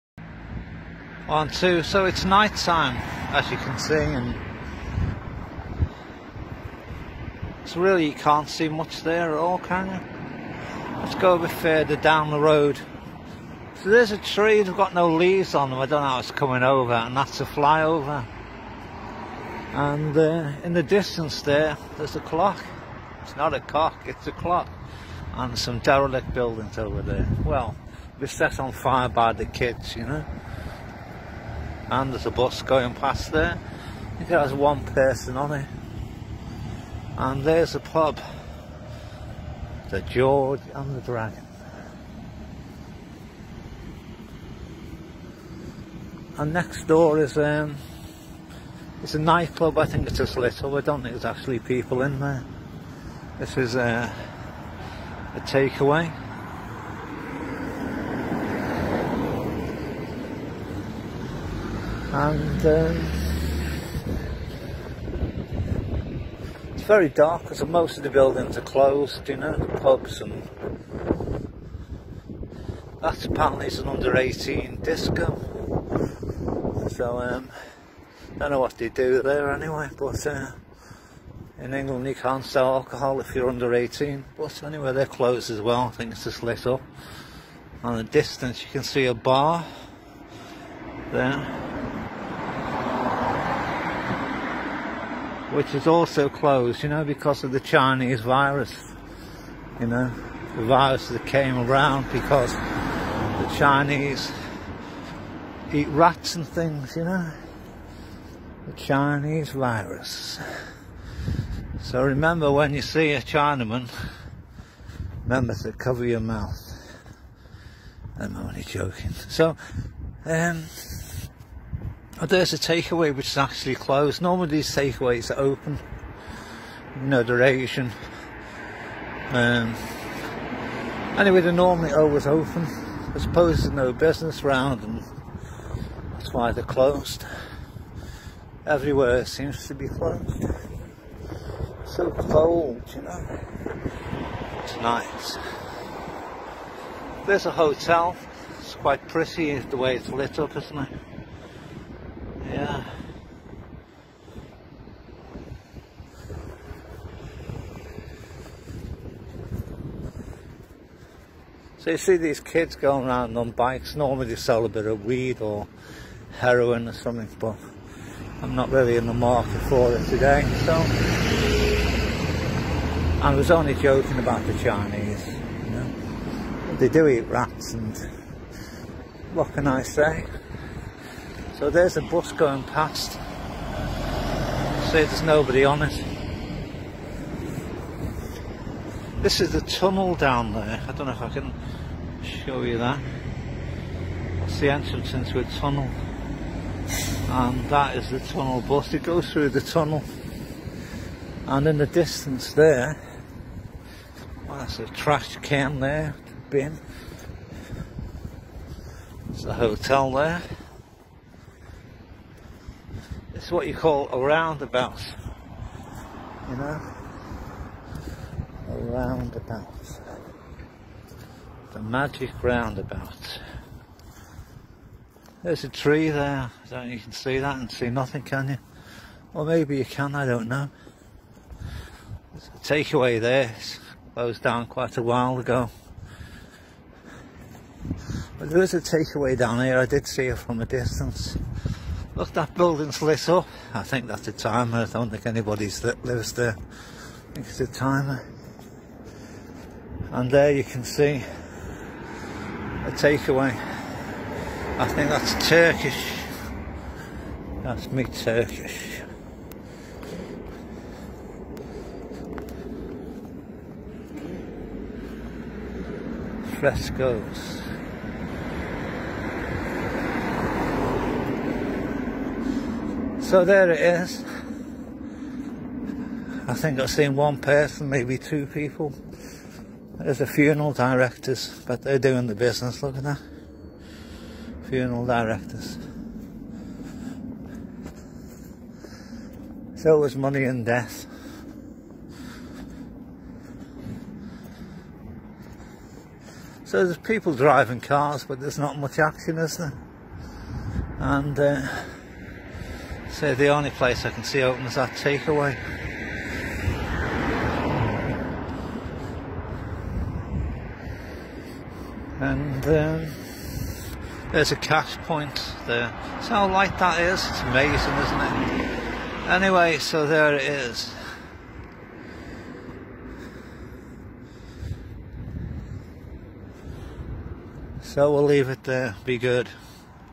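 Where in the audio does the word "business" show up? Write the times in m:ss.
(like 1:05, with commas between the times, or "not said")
2:13, 4:42.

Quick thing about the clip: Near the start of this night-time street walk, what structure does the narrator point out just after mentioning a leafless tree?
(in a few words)
flyover.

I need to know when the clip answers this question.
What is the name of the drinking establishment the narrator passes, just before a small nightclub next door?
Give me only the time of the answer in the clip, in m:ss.
0:39.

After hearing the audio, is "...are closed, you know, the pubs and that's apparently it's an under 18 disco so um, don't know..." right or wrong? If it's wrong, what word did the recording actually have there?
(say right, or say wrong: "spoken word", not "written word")
right.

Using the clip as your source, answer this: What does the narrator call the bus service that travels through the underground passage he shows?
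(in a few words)
tunnel bus.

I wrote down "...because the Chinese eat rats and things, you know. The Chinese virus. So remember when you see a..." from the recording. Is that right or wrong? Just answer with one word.
right.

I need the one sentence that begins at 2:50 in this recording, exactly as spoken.
So I was only joking about the Chinese.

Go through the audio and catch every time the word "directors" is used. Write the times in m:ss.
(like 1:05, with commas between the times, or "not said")
4:40, 4:45.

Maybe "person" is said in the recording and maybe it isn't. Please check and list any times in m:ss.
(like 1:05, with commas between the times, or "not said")
0:34, 4:37.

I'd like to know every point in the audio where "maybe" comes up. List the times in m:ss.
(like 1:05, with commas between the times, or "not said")
3:49, 4:37.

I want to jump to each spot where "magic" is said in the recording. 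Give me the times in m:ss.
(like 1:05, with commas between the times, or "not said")
3:41.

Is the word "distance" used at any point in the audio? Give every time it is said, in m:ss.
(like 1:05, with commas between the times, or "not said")
0:20, 1:28, 3:21, 4:00.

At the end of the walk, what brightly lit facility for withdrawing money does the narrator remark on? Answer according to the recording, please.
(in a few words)
cash point.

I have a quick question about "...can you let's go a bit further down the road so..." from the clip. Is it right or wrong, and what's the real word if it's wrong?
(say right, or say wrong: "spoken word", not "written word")
right.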